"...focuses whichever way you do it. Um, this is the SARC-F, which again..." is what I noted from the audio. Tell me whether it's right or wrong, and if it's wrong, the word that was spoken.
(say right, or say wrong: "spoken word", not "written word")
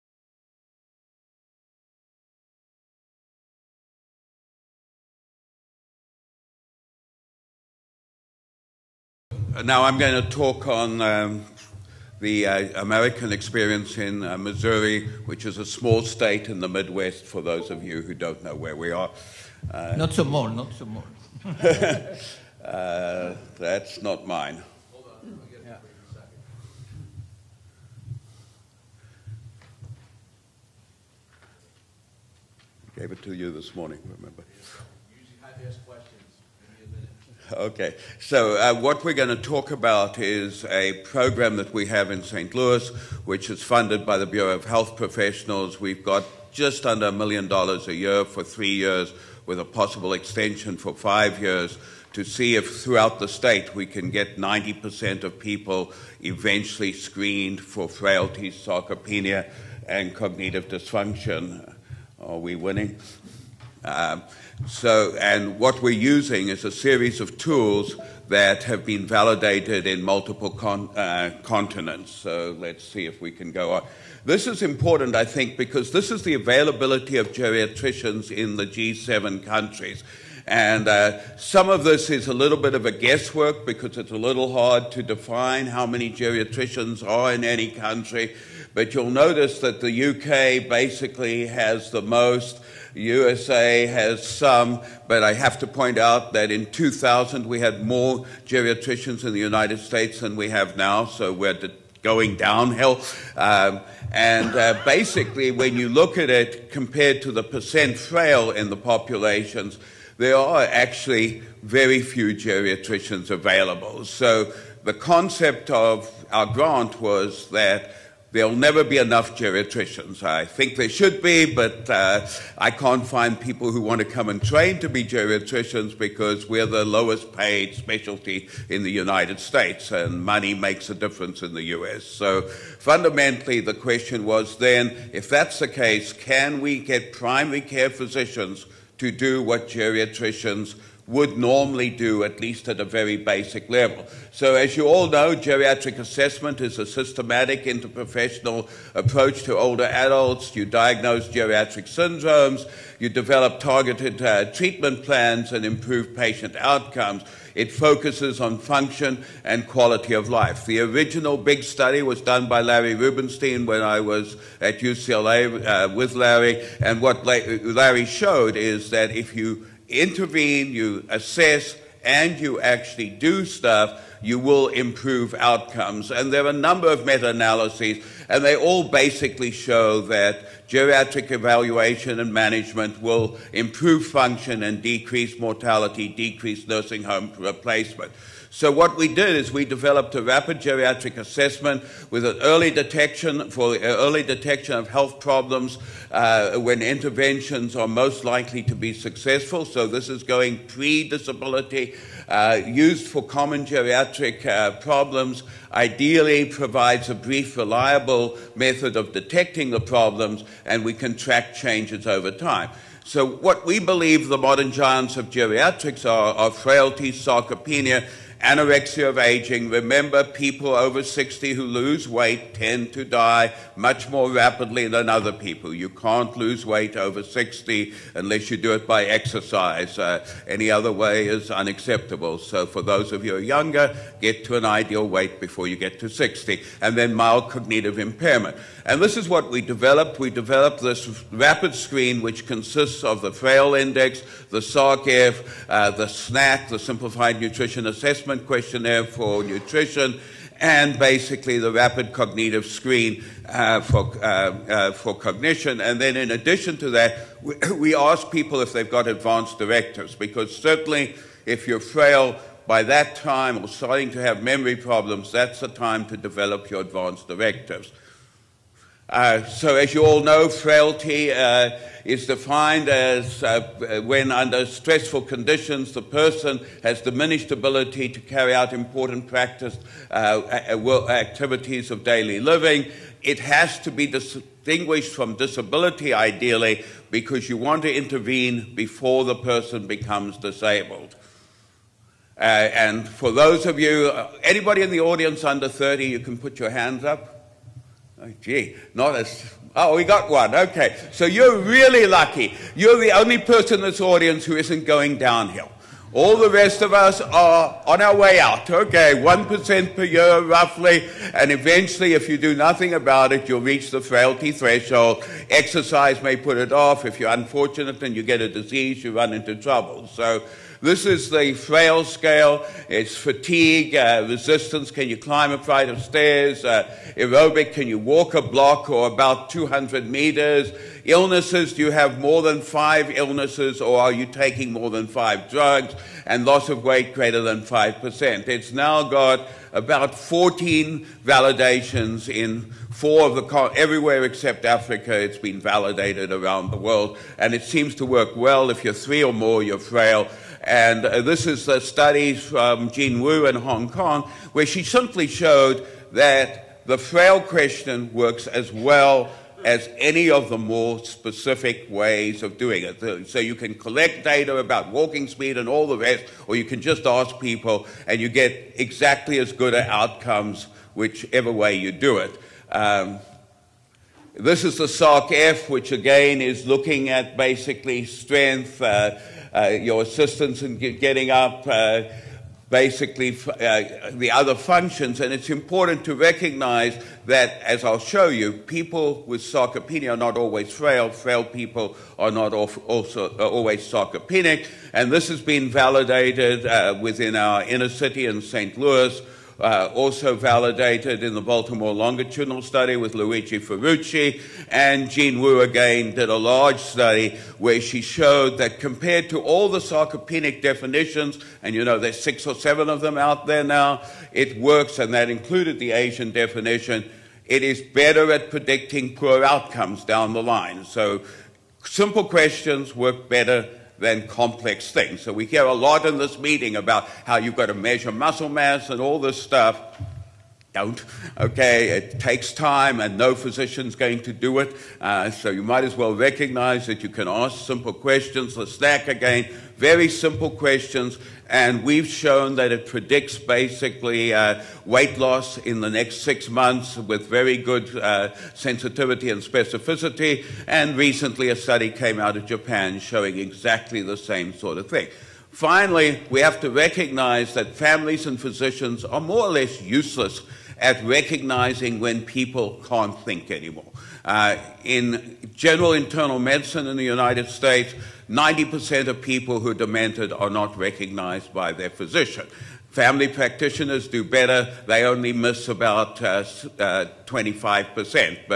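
wrong: "outcomes", not "focuses".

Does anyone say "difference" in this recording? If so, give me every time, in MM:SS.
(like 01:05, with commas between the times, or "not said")
02:10.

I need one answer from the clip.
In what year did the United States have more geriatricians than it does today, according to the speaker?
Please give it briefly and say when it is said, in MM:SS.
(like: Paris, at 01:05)
2000, at 01:36.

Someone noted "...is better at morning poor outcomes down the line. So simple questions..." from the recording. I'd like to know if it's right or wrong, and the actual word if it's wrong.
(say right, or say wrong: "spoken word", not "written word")
wrong: "predicting", not "morning".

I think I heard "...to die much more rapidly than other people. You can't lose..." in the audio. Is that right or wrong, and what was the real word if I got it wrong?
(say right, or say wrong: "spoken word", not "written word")
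right.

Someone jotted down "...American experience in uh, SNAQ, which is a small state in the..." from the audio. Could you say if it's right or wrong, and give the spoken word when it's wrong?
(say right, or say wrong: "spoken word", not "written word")
wrong: "Missouri", not "SNAQ".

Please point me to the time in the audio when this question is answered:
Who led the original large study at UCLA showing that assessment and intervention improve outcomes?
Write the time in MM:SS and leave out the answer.
02:42.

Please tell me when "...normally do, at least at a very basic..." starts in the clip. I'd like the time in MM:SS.
02:21.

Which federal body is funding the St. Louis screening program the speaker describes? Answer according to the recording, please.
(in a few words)
Bureau of Health Professionals.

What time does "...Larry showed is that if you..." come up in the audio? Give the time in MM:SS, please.
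02:47.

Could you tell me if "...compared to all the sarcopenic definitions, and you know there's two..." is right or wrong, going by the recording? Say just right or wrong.
wrong.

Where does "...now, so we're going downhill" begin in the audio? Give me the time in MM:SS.
01:40.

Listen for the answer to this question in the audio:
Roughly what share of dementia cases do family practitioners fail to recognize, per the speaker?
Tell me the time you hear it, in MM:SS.
07:57.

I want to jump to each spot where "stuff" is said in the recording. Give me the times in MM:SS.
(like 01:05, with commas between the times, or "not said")
02:53, 07:09.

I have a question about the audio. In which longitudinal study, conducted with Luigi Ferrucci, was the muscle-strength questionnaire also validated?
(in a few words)
Baltimore longitudinal study.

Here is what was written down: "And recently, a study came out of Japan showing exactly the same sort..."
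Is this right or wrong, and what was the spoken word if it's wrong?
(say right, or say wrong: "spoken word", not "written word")
right.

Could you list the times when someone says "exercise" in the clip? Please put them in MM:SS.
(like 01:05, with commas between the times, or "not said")
03:49, 05:15.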